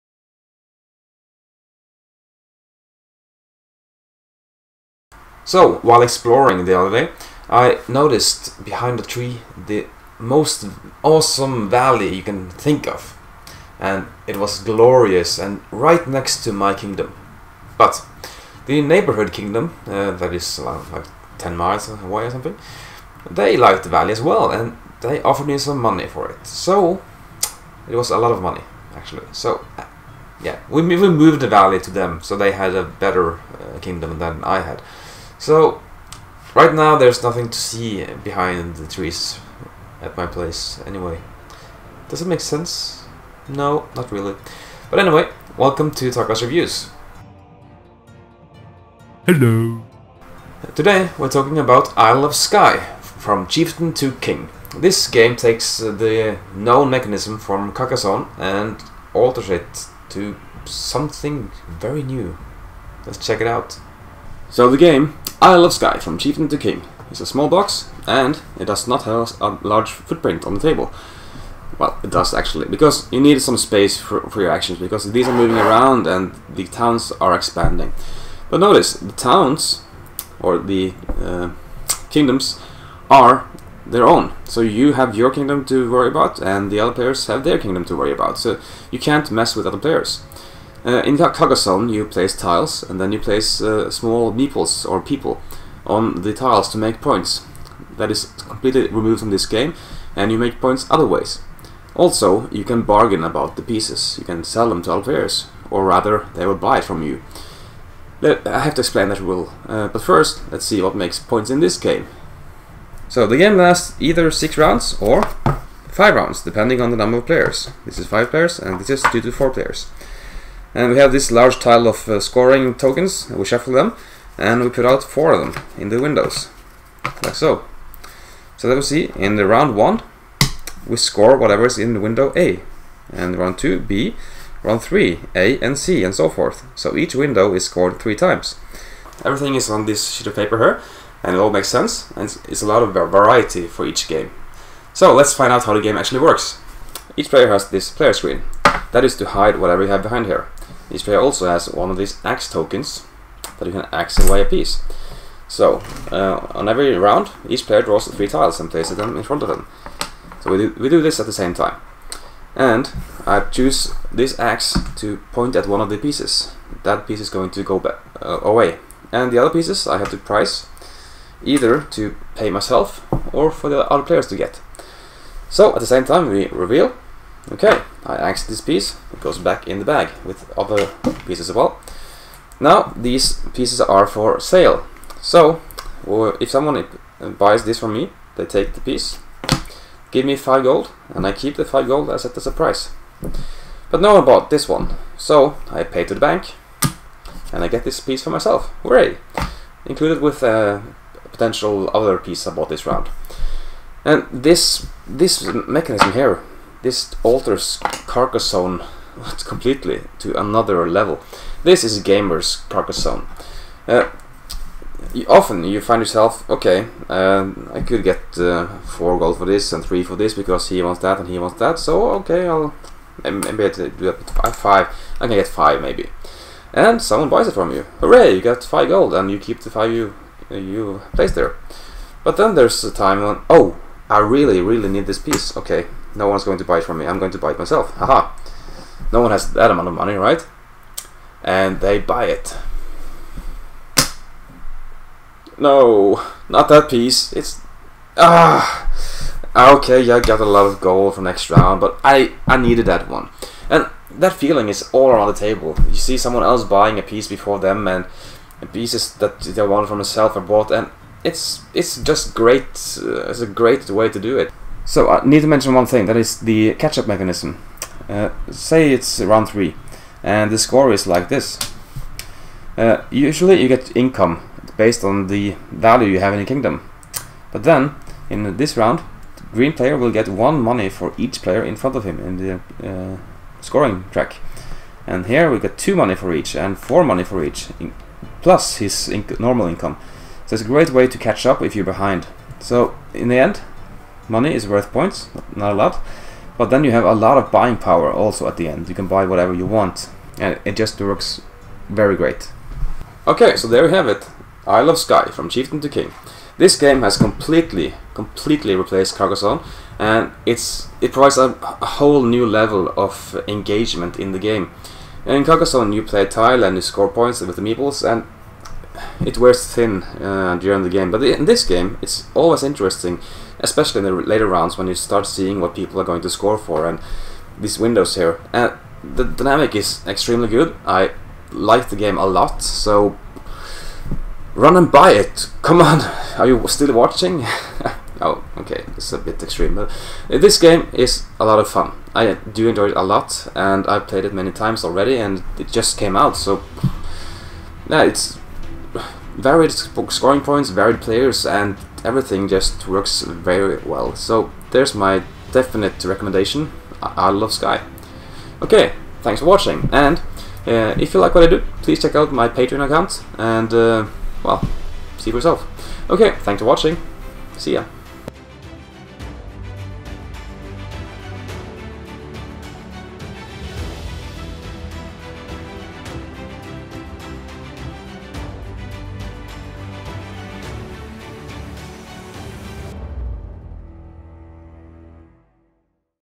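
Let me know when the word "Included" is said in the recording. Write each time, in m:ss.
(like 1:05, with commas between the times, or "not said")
3:19.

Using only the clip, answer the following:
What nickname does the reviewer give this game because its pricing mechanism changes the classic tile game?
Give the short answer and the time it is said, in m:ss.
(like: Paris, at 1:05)
gamer's Carcassonne, at 3:32.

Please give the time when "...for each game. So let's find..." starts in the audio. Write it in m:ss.
2:23.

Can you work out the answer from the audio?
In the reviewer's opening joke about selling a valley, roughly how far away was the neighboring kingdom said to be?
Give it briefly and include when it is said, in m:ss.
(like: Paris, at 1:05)
10 miles, at 0:21.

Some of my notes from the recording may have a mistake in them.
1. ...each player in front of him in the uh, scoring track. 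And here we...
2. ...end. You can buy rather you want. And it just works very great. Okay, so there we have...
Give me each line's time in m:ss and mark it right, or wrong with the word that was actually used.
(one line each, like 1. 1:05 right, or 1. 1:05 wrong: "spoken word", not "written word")
1. 4:41 right
2. 4:58 wrong: "whatever", not "rather".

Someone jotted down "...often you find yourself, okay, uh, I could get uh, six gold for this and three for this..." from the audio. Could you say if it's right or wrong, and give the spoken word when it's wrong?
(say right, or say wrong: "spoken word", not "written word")
wrong: "four", not "six".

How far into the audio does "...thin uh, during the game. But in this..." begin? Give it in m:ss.
5:19.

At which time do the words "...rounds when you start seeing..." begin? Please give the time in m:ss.
5:24.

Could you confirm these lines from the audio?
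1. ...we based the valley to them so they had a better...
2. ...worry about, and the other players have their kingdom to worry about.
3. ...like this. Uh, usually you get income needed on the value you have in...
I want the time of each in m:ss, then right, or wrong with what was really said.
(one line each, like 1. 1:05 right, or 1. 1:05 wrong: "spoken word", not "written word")
1. 0:30 wrong: "moved", not "based"
2. 1:25 right
3. 4:31 wrong: "based", not "needed".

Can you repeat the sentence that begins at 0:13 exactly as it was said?
And it was glorious and right next to my kingdom.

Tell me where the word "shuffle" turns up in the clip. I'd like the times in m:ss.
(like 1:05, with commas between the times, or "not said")
2:03.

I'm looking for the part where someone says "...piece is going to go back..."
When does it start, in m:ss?
2:47.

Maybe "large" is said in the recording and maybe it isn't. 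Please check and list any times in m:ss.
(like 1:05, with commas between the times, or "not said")
1:09, 2:01.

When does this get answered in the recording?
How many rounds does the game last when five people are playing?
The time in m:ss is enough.
1:55.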